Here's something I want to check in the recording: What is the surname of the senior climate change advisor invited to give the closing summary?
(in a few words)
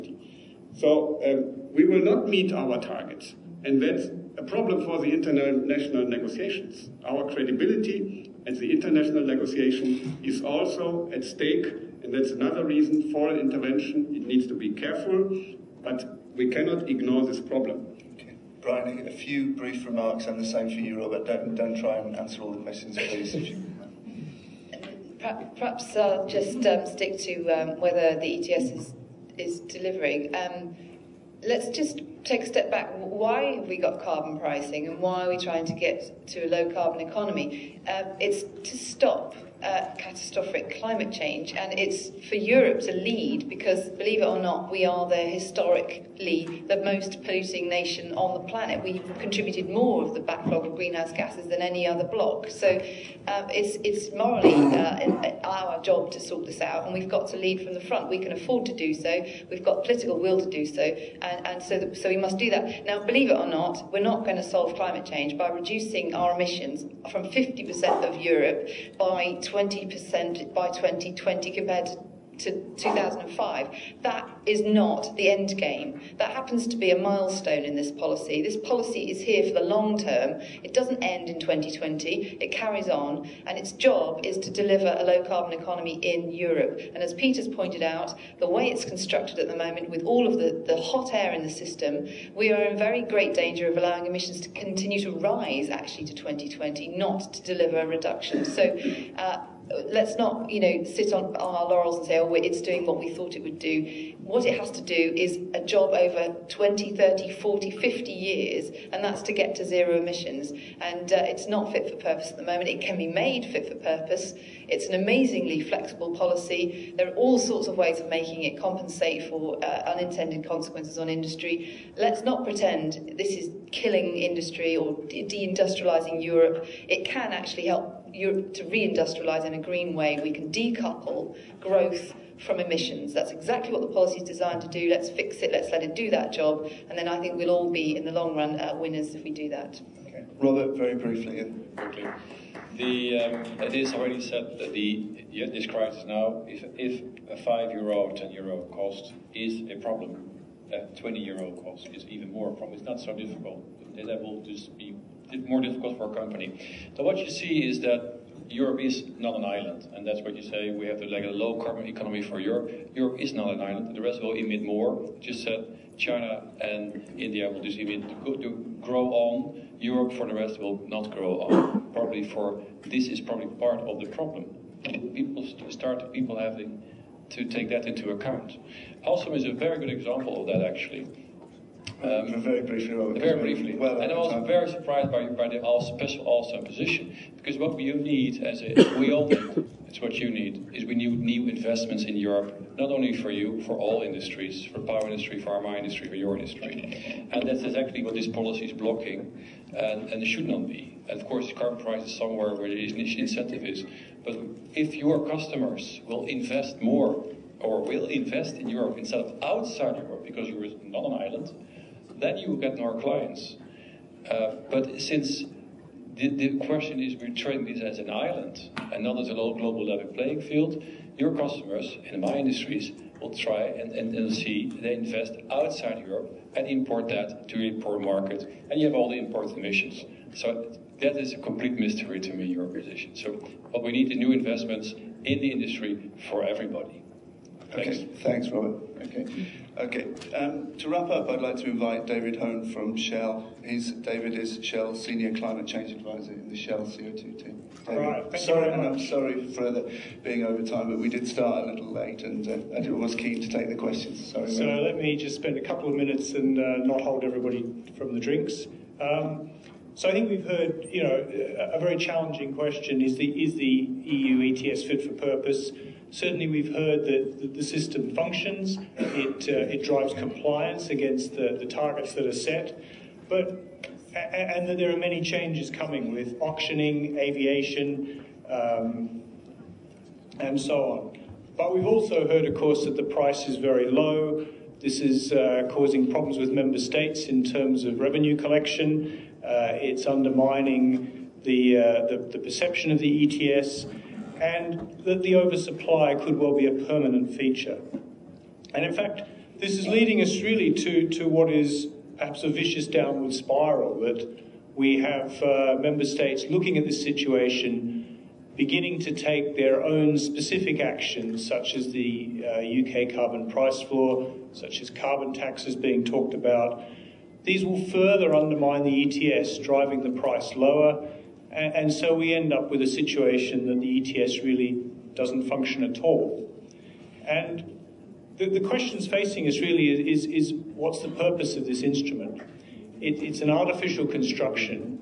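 Hone.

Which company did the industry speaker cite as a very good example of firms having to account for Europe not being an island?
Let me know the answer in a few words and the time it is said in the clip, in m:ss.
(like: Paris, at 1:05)
Alstom, at 2:59.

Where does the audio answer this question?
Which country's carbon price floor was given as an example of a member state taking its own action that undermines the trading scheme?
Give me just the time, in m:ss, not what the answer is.
5:13.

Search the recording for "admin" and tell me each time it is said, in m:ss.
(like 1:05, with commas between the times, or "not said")
not said.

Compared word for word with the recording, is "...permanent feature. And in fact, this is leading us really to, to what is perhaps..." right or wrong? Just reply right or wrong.
right.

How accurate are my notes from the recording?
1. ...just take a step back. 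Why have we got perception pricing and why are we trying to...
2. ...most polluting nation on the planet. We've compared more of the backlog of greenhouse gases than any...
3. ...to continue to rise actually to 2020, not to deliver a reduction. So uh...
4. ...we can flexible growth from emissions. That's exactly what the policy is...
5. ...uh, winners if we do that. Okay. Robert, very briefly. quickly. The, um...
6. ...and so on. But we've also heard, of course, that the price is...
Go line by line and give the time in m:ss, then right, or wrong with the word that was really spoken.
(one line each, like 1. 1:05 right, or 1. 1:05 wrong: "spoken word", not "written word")
1. 0:31 wrong: "carbon", not "perception"
2. 0:46 wrong: "contributed", not "compared"
3. 1:34 right
4. 2:10 wrong: "decouple", not "flexible"
5. 2:18 right
6. 4:40 right.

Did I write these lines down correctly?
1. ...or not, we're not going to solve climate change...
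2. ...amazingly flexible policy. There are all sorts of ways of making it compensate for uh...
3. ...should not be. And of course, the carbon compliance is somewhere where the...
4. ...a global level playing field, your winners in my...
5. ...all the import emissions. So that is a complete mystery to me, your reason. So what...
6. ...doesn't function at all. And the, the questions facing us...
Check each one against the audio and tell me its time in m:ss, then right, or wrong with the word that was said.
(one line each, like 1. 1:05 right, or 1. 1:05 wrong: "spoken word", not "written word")
1. 1:03 right
2. 1:54 right
3. 3:20 wrong: "price", not "compliance"
4. 3:39 wrong: "customers", not "winners"
5. 3:48 wrong: "position", not "reason"
6. 5:25 right.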